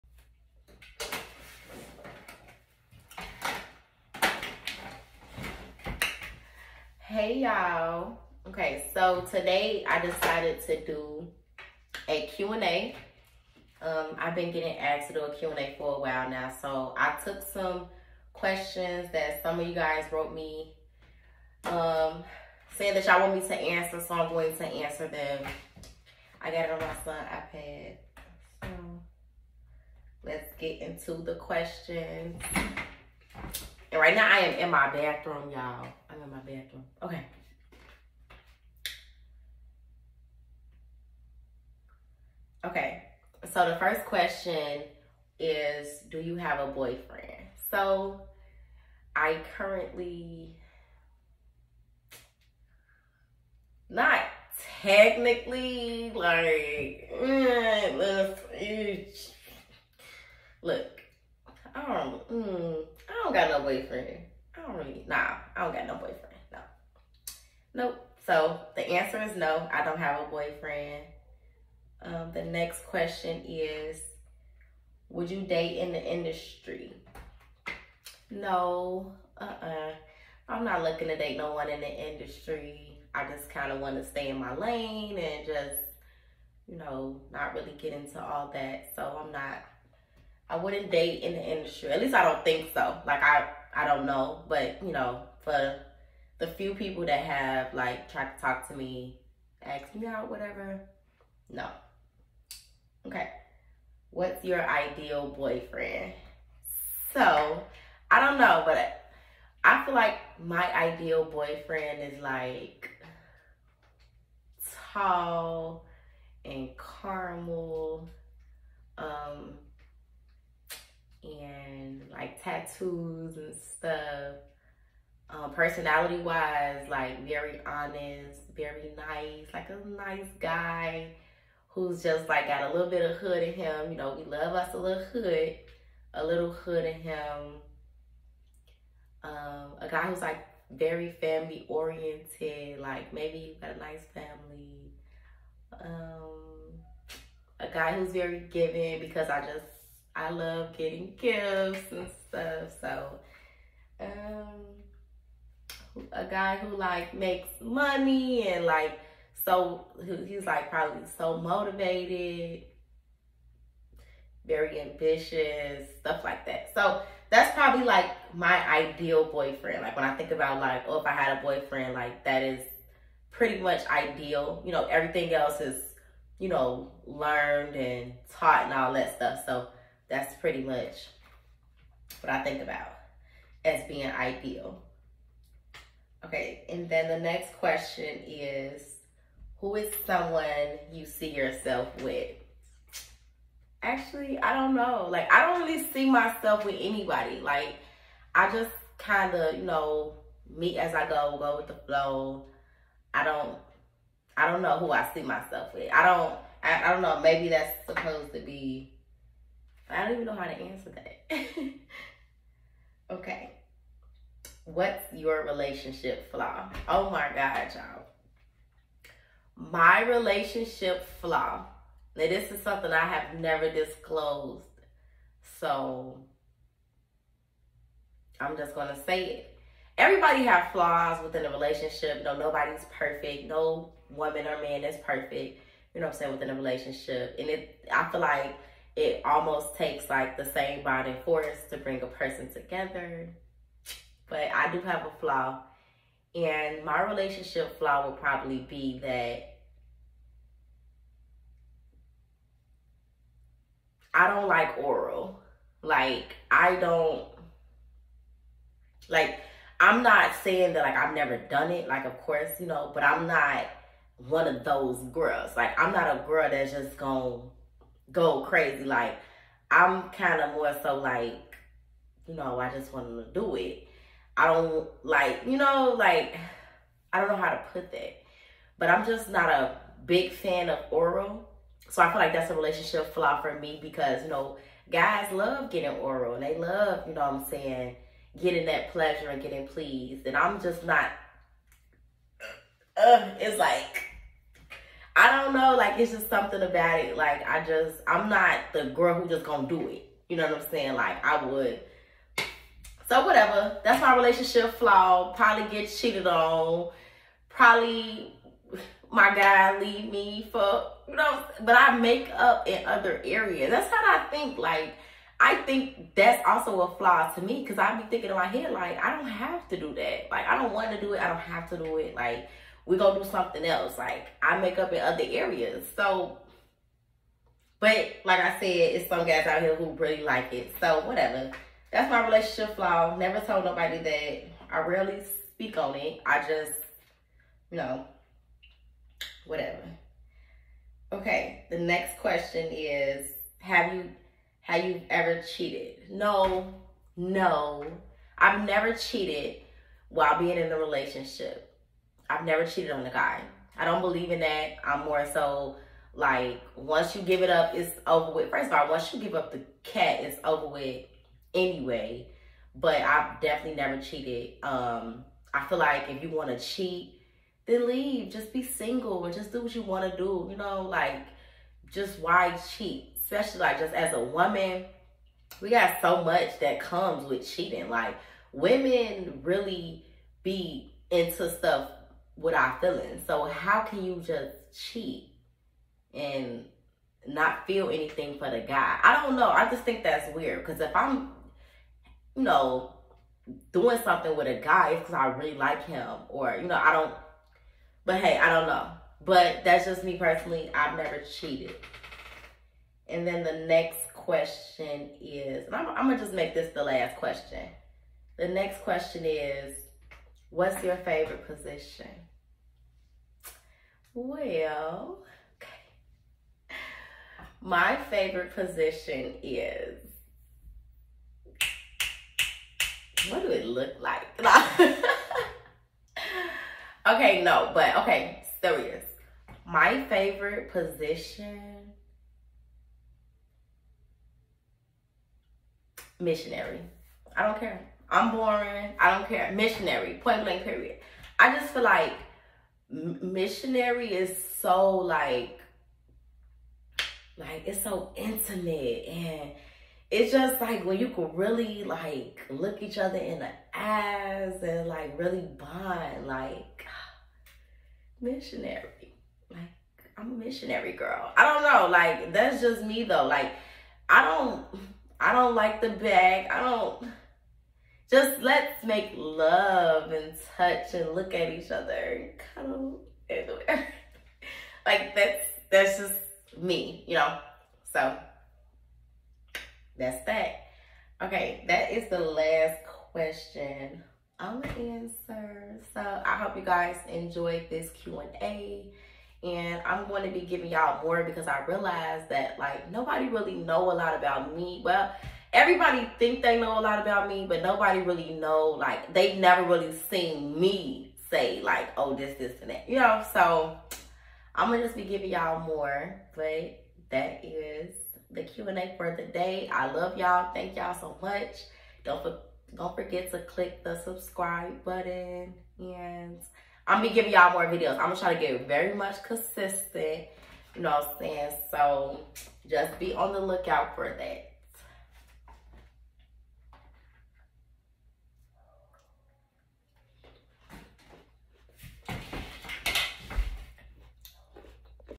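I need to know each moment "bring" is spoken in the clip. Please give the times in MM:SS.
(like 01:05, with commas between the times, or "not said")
04:01.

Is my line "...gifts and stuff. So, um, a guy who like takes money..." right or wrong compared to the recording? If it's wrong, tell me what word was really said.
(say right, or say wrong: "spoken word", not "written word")
wrong: "makes", not "takes".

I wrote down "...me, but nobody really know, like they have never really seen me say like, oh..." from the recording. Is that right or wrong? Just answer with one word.
right.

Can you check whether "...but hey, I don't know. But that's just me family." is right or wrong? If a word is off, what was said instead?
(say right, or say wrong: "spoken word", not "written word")
wrong: "personally", not "family".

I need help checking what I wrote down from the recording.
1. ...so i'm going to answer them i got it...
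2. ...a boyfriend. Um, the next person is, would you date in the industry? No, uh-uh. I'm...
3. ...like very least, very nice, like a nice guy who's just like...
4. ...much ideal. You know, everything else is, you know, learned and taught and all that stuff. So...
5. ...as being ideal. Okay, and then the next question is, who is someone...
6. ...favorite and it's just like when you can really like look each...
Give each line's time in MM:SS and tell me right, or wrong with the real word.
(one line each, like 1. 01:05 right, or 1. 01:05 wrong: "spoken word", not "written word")
1. 00:24 right
2. 01:10 wrong: "question", not "person"
3. 02:06 wrong: "honest", not "least"
4. 02:53 right
5. 03:03 right
6. 07:28 wrong: "intimate", not "favorite".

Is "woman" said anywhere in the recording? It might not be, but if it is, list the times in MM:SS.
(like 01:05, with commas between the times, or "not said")
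03:54, 06:14.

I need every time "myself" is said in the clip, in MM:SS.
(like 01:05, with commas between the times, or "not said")
03:16, 03:25.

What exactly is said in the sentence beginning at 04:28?
Like, I'm kind of more so like, you know, I just want to do it.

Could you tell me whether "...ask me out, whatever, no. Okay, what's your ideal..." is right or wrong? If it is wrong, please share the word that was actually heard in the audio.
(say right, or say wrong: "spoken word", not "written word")
right.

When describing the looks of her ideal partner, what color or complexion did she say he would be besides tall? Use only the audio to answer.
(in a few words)
Caramel.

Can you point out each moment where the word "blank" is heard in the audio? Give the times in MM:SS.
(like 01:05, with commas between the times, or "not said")
07:20.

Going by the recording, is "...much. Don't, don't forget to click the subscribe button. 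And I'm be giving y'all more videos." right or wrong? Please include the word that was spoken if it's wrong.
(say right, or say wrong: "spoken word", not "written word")
right.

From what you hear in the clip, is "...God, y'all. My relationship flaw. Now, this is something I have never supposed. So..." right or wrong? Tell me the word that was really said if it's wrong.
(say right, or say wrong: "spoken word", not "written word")
wrong: "disclosed", not "supposed".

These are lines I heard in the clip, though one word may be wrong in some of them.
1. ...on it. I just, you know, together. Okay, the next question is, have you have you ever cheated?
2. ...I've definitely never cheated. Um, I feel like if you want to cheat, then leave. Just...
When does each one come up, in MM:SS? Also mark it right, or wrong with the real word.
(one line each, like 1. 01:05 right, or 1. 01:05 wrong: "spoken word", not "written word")
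1. 05:35 wrong: "whatever", not "together"
2. 06:03 right.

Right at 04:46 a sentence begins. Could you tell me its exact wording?
They love, you know what I'm saying, getting that pleasure and getting pleased.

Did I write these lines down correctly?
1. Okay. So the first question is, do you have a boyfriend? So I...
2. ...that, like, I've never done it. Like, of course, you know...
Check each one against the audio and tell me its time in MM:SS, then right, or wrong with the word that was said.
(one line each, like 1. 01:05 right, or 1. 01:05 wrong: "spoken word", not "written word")
1. 00:42 right
2. 04:20 right.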